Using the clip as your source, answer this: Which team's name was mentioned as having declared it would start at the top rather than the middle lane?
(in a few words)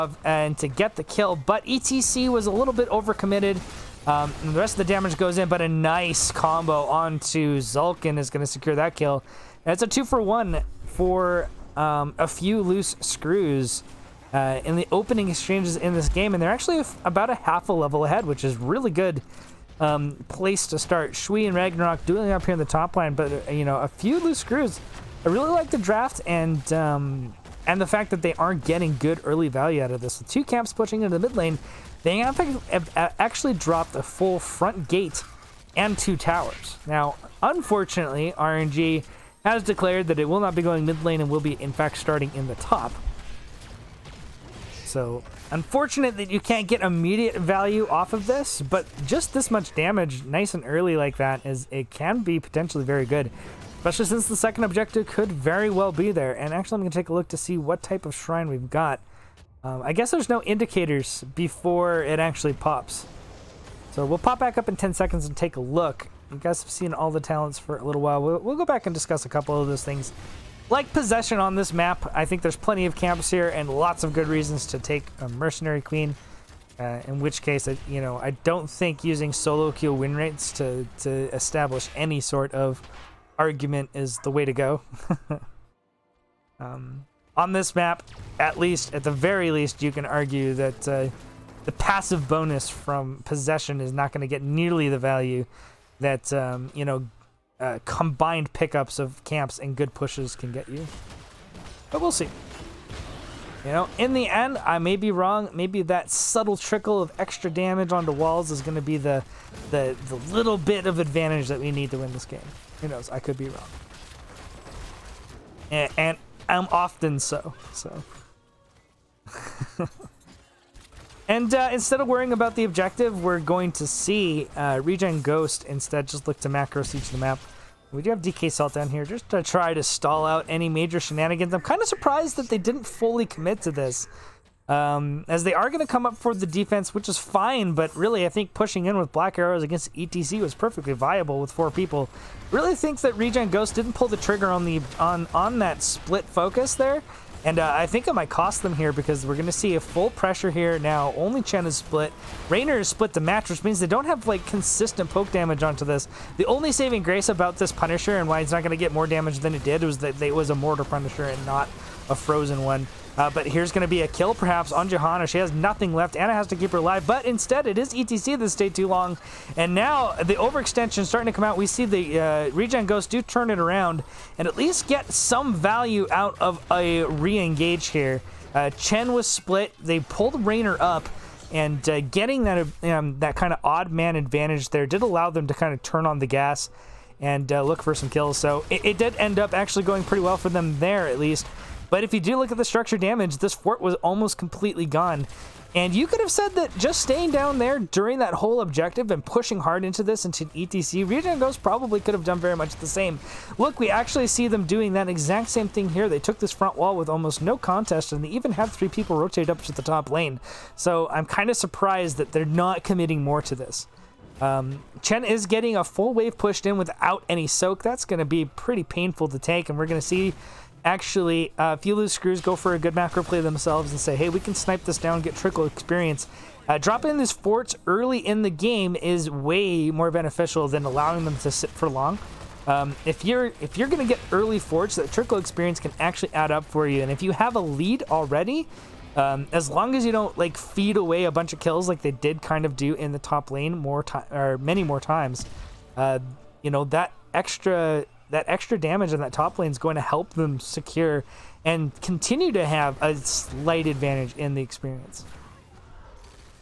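RNG.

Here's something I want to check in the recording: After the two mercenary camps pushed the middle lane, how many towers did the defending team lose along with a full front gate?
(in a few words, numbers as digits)
2.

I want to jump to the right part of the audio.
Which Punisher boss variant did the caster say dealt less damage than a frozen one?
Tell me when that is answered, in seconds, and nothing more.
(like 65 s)
160 s.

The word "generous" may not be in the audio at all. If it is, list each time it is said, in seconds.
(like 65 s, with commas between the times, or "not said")
not said.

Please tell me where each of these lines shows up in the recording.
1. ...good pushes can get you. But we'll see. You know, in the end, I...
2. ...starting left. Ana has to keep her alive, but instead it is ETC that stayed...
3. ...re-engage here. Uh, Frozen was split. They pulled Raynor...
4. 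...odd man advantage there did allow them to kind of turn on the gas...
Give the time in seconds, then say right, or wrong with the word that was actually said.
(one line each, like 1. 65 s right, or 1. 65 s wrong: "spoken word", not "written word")
1. 99 s right
2. 165 s wrong: "nothing", not "starting"
3. 177 s wrong: "Chen", not "Frozen"
4. 183 s right.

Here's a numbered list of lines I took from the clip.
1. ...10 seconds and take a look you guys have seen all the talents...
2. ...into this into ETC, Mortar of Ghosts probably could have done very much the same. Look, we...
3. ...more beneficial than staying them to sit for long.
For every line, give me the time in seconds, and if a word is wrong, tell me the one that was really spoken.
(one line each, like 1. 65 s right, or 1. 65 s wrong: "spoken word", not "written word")
1. 64 s right
2. 199 s wrong: "Region", not "Mortar"
3. 229 s wrong: "allowing", not "staying".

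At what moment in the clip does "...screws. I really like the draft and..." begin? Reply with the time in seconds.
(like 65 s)
24 s.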